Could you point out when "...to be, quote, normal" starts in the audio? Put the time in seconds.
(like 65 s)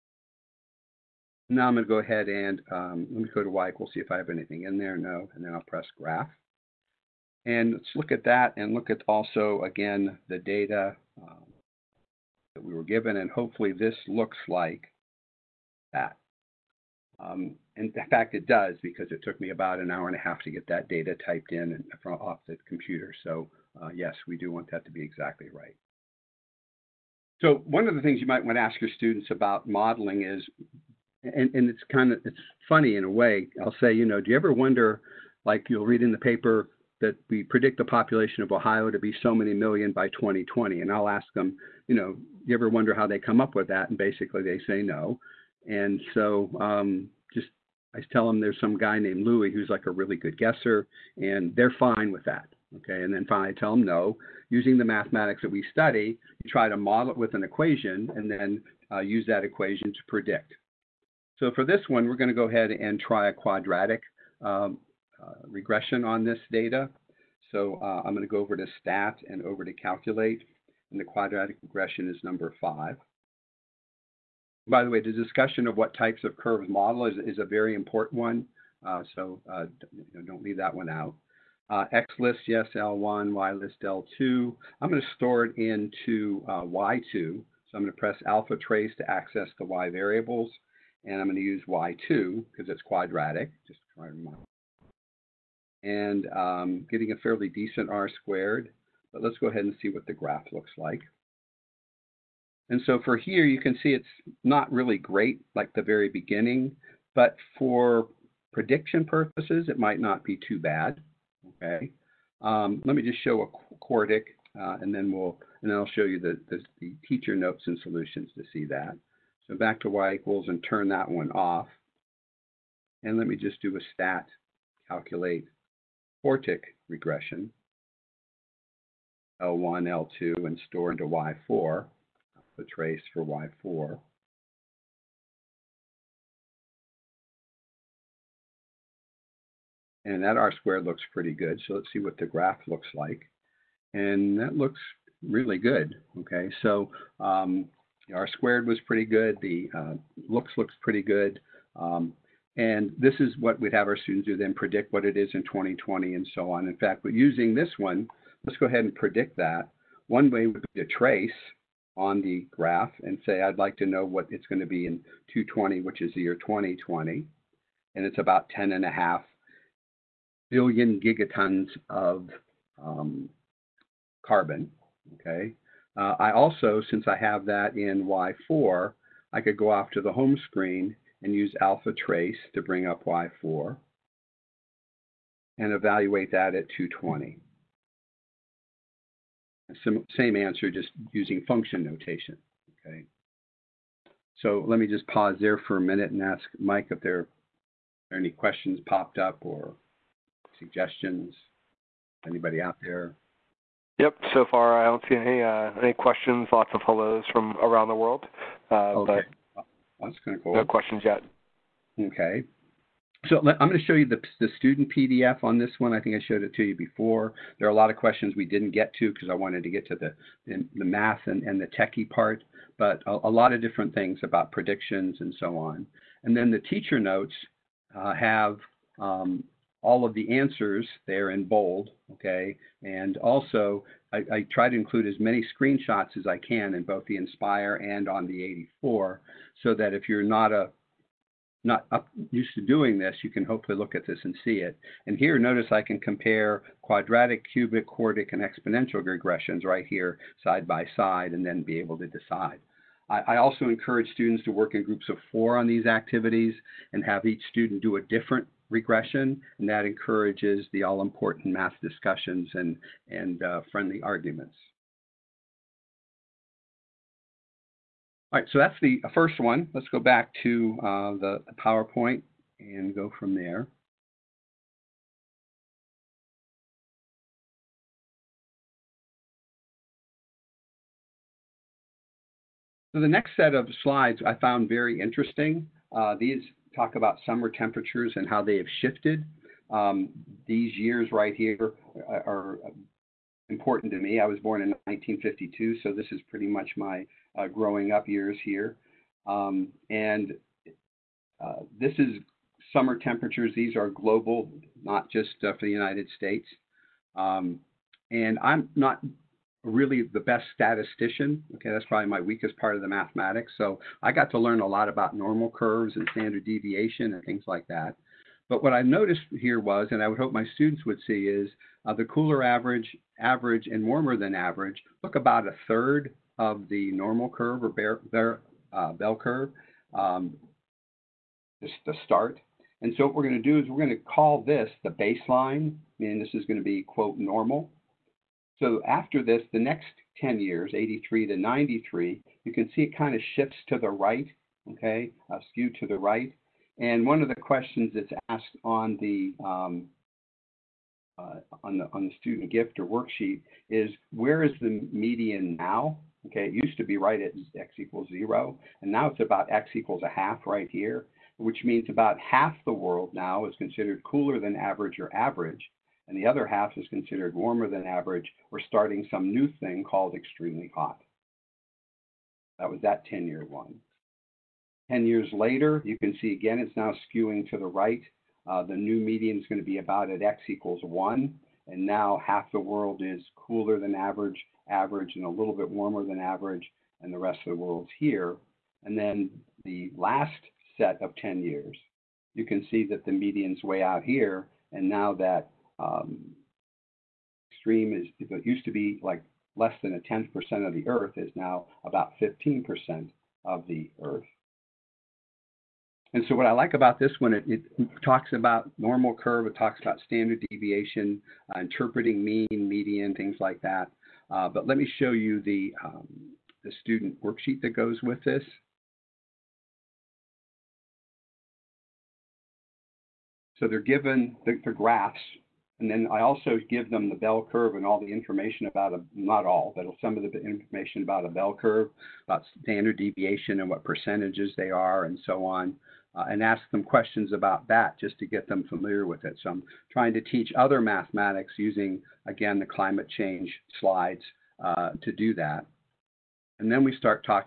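336 s.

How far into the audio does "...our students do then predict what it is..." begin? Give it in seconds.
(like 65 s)
153 s.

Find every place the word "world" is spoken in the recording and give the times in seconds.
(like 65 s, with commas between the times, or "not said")
207 s, 362 s, 382 s, 387 s.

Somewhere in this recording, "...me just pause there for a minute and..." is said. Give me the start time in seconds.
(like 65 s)
194 s.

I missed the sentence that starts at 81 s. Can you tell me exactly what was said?
Uh, X list, yes, L1, Y list, L2.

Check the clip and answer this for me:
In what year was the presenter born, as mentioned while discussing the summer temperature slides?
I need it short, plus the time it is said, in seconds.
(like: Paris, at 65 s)
1952, at 294 s.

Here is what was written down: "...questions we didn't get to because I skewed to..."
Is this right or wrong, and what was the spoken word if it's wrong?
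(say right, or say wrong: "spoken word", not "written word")
wrong: "wanted", not "skewed".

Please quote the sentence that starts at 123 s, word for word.
And let me just do a stat, calculate quartic regression, L1, L2, and store into Y4 the trace for y4.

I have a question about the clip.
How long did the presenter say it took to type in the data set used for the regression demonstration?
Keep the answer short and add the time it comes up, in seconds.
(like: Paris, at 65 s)
an hour and a half, at 19 s.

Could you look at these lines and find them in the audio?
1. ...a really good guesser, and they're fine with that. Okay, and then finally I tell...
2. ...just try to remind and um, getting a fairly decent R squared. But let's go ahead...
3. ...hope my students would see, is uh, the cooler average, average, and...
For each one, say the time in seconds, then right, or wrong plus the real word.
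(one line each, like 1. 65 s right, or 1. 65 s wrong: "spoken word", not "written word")
1. 49 s right
2. 93 s right
3. 320 s right.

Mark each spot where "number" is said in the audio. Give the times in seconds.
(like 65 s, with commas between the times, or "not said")
72 s.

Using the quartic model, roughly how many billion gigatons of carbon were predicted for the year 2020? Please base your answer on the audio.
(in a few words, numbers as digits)
10.5.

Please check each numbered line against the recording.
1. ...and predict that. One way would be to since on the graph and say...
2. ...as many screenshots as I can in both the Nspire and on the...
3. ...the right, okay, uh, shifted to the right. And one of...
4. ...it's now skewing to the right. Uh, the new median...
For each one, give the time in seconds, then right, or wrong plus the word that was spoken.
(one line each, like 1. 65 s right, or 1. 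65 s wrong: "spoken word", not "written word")
1. 158 s wrong: "trace", not "since"
2. 235 s right
3. 343 s wrong: "skewed", not "shifted"
4. 376 s right.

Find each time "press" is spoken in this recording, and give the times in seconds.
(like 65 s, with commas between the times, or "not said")
5 s, 87 s.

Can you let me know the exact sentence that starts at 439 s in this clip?
So I'm trying to teach other mathematics using, again, the climate change slides uh, to do that.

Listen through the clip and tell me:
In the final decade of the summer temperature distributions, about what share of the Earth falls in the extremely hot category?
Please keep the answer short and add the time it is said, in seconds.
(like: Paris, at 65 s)
15%, at 402 s.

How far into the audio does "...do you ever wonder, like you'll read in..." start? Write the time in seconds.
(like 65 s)
34 s.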